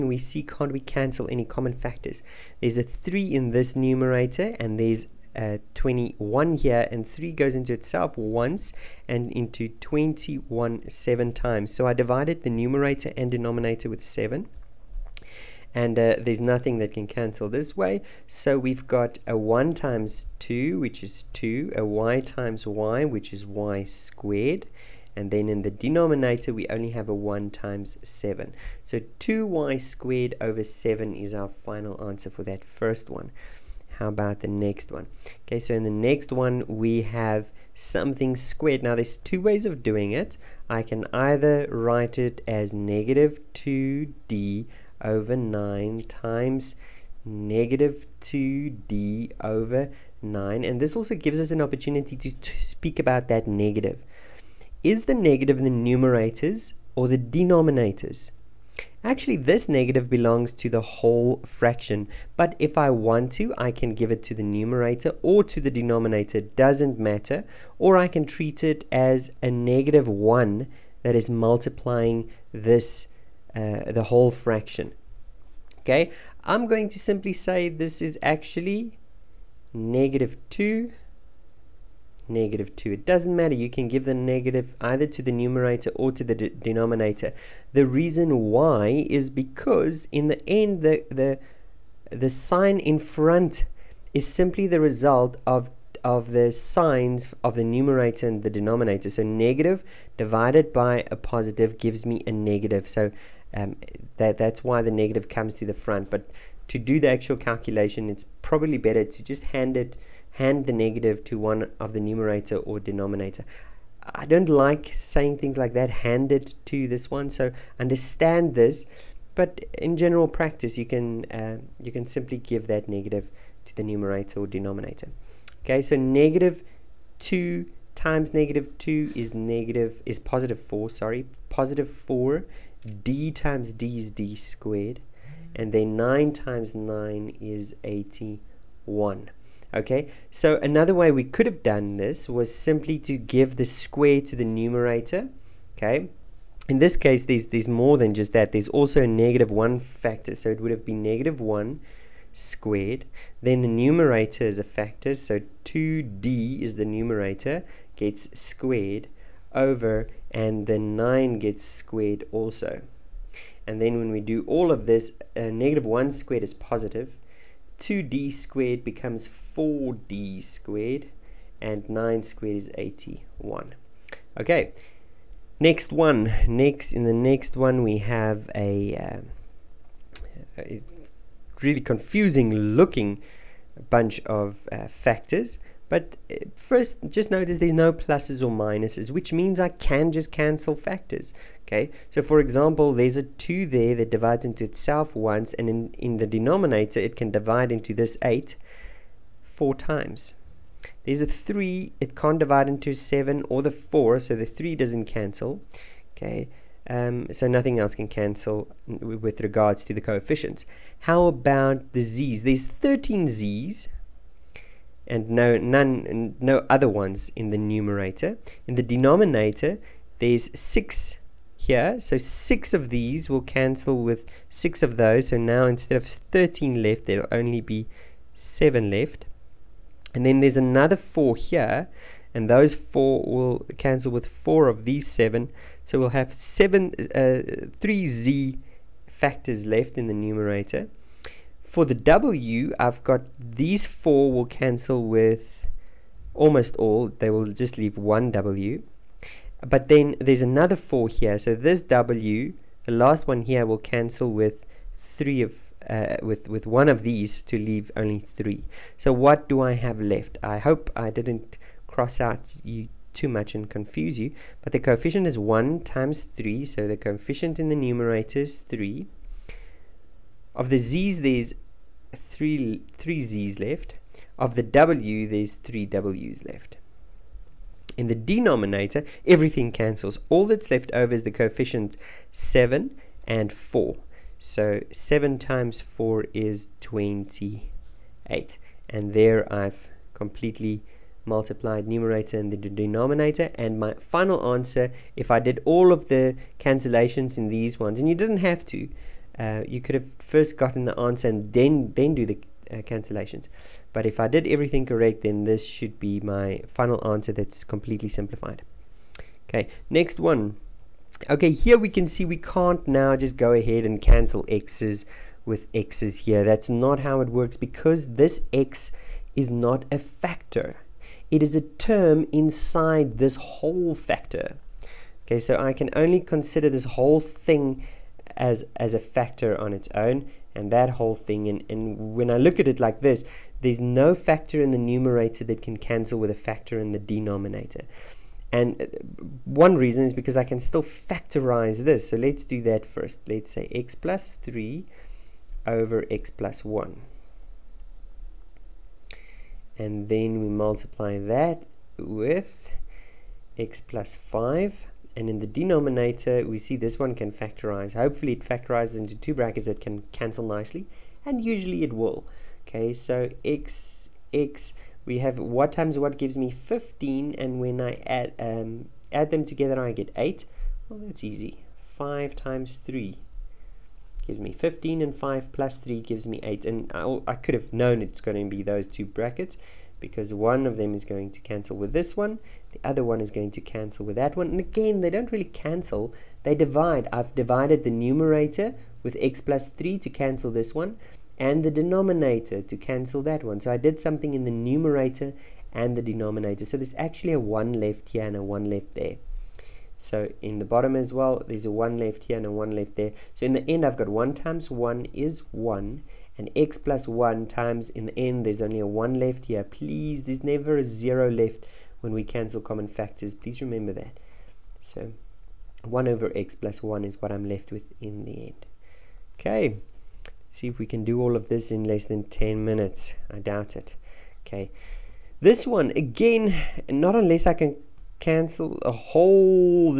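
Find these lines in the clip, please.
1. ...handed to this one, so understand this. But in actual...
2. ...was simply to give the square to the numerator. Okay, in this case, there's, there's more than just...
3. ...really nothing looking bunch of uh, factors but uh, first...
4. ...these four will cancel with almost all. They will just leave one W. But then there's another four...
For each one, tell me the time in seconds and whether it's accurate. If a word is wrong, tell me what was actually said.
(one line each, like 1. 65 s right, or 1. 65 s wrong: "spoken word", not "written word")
1. 115 s wrong: "general", not "actual"
2. 142 s right
3. 181 s wrong: "confusing", not "nothing"
4. 243 s right.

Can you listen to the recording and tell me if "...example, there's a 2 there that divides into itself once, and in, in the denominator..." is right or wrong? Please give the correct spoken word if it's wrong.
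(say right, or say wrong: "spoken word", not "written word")
right.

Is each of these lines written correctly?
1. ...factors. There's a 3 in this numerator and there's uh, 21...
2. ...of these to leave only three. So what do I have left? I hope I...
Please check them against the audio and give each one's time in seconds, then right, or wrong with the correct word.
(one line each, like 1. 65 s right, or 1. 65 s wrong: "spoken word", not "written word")
1. 1 s right
2. 256 s right.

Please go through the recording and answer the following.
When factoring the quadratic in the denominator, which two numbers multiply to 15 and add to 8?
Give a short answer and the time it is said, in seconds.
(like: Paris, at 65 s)
5 and 3, at 371 s.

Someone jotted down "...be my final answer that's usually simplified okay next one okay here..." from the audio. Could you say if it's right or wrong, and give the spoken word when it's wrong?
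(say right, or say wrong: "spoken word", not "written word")
wrong: "completely", not "usually".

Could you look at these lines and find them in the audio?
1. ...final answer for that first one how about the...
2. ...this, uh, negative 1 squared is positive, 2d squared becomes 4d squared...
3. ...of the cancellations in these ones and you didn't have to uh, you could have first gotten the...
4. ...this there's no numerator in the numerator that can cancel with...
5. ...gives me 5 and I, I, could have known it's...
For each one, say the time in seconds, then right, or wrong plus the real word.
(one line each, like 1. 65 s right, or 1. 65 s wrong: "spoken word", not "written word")
1. 31 s right
2. 164 s right
3. 295 s right
4. 333 s wrong: "factor", not "numerator"
5. 375 s wrong: "8", not "5".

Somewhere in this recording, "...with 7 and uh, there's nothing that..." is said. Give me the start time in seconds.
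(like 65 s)
13 s.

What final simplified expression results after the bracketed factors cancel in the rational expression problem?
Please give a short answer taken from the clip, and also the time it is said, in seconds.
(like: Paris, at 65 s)
1 over x plus 1, at 415 s.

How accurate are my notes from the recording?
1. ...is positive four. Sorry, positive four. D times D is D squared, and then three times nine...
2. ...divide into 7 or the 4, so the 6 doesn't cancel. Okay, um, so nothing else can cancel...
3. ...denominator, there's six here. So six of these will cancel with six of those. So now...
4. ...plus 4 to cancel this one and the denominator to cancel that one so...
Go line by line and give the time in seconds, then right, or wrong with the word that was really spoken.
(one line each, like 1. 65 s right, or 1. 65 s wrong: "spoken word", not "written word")
1. 130 s wrong: "nine", not "three"
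2. 202 s wrong: "3", not "6"
3. 218 s right
4. 389 s wrong: "3", not "4".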